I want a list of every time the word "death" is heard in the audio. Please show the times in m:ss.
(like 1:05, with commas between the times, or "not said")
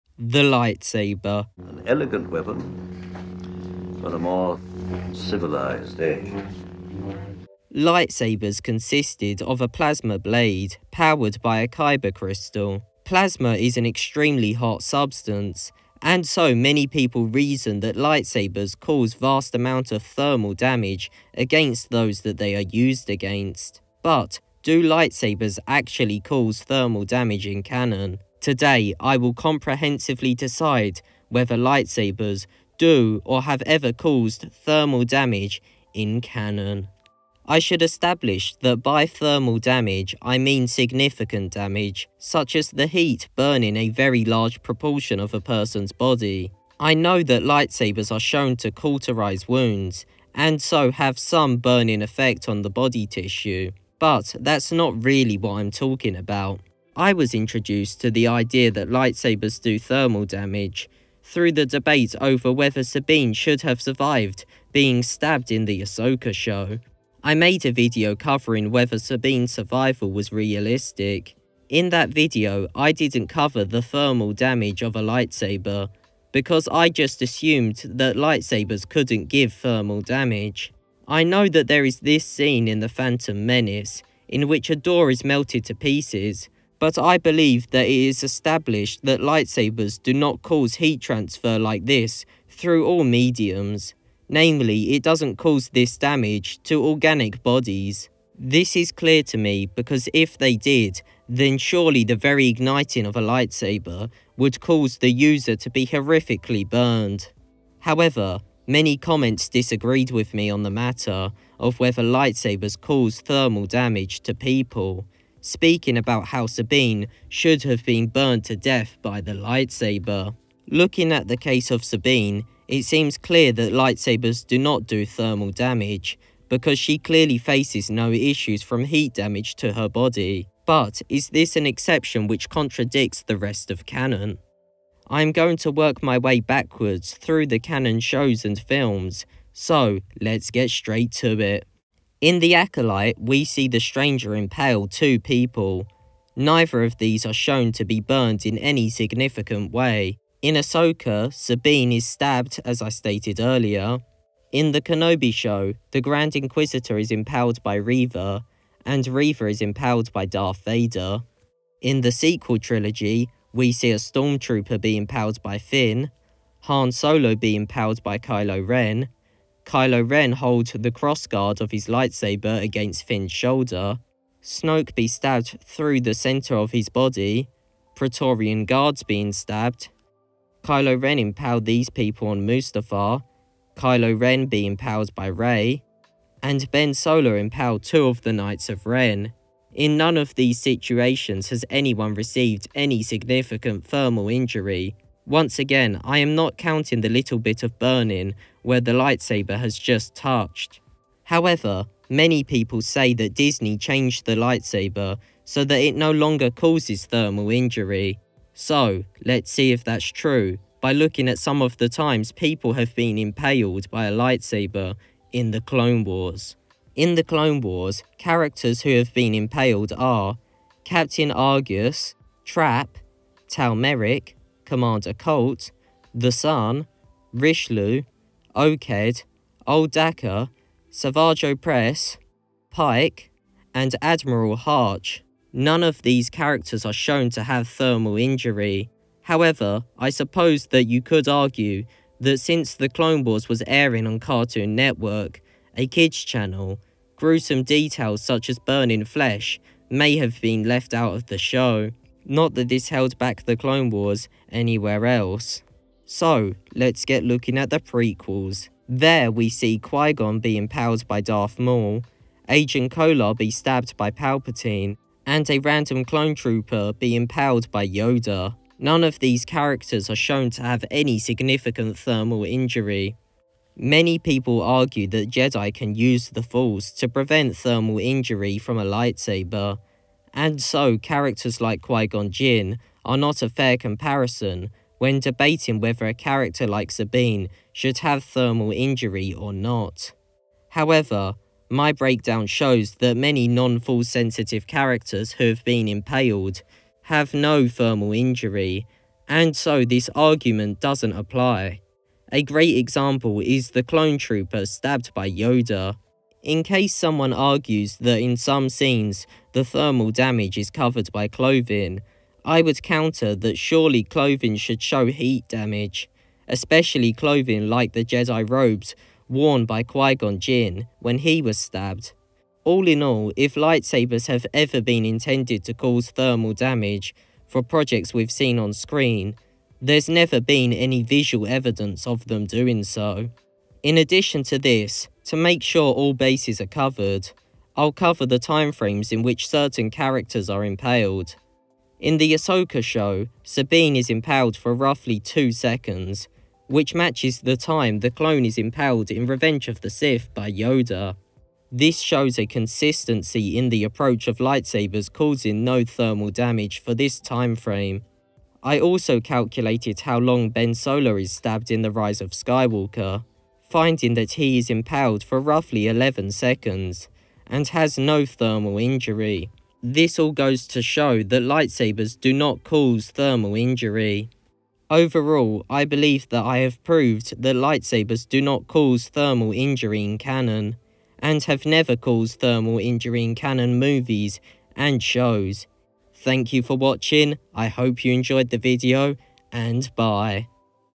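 1:58.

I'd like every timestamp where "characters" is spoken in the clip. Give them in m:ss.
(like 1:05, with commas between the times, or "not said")
3:38, 3:56, 4:29, 4:40, 4:46, 4:54, 5:39.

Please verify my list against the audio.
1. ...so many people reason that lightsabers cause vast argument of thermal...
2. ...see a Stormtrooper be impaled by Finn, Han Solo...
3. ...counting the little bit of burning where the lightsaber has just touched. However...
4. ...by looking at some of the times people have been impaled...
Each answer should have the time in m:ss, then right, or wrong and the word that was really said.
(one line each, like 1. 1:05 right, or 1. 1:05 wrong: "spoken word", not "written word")
1. 0:16 wrong: "amount", not "argument"
2. 2:43 right
3. 3:16 right
4. 3:30 right.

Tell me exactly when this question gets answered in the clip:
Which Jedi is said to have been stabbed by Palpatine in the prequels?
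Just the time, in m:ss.
4:22.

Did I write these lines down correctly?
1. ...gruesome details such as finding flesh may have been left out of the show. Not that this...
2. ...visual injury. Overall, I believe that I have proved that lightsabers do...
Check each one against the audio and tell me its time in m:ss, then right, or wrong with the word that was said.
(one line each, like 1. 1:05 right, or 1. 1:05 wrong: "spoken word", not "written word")
1. 4:07 wrong: "burning", not "finding"
2. 6:13 wrong: "thermal", not "visual".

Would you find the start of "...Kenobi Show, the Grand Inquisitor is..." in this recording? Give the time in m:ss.
2:34.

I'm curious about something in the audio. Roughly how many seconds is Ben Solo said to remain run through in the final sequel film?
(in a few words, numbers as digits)
11.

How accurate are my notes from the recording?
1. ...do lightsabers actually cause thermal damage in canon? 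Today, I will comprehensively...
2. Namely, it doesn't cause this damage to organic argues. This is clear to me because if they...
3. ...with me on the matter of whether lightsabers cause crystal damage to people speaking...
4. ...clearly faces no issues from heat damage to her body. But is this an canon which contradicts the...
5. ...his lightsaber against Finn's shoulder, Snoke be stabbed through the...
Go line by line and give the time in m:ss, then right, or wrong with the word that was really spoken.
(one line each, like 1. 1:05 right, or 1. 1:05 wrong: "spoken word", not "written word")
1. 0:24 right
2. 1:34 wrong: "bodies", not "argues"
3. 1:50 wrong: "thermal", not "crystal"
4. 2:06 wrong: "exception", not "canon"
5. 2:51 right.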